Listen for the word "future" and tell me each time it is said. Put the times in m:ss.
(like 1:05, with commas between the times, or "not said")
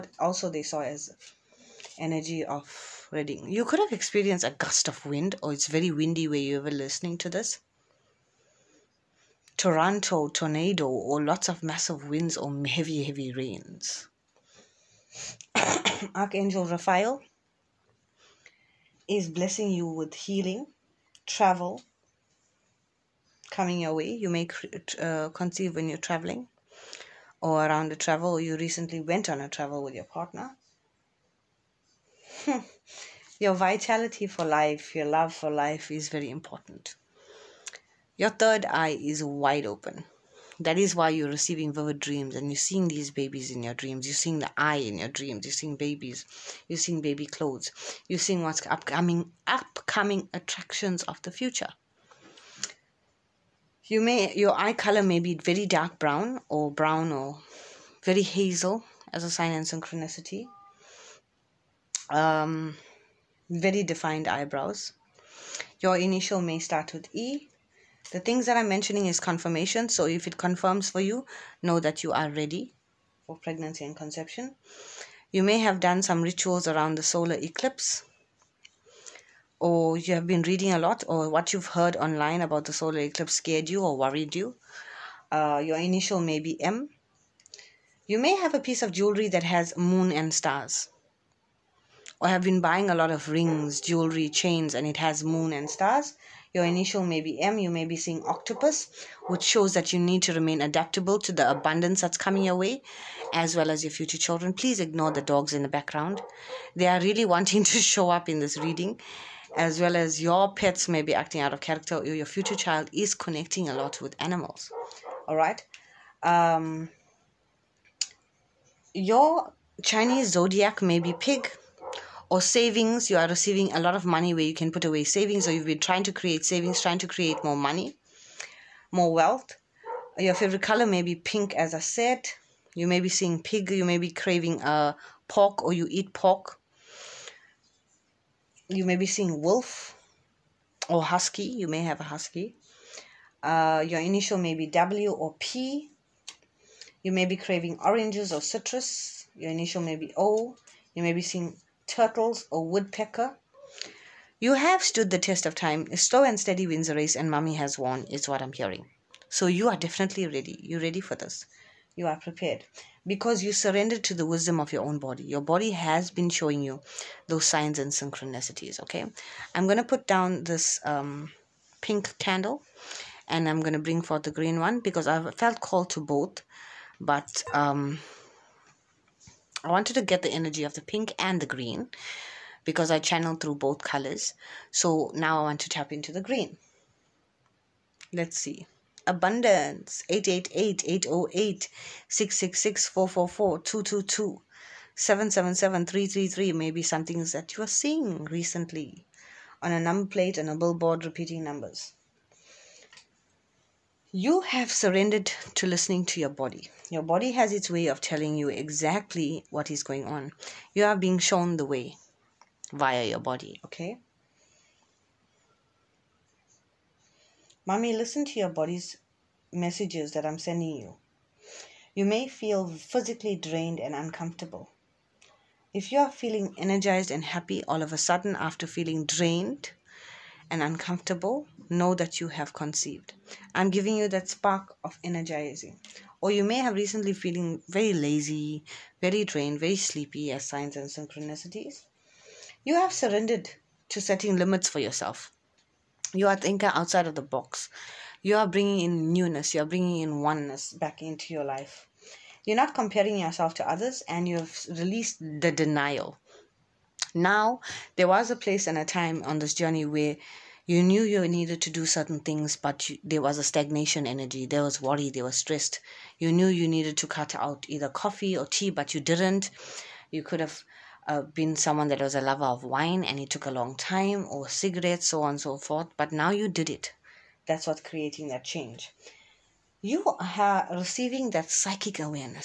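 0:51, 1:43, 1:52.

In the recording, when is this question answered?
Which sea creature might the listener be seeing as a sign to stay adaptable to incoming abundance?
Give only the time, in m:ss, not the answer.
1:38.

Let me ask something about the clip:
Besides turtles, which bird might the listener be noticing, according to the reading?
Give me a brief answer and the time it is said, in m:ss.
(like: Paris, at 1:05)
Woodpecker, at 2:32.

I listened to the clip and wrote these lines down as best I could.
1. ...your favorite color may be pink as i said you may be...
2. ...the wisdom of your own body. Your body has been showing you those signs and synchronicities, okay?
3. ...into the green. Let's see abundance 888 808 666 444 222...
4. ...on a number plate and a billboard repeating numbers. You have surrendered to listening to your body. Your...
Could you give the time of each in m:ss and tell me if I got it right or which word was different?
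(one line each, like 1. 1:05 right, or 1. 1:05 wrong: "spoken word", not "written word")
1. 2:10 right
2. 2:44 right
3. 3:05 right
4. 3:19 right.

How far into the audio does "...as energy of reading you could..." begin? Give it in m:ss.
0:00.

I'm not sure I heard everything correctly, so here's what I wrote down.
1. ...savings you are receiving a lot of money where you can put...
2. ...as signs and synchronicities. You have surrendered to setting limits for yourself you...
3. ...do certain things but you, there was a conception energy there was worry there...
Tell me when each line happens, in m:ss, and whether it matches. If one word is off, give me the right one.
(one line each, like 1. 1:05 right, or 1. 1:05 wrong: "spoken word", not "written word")
1. 2:02 right
2. 4:00 right
3. 4:21 wrong: "stagnation", not "conception".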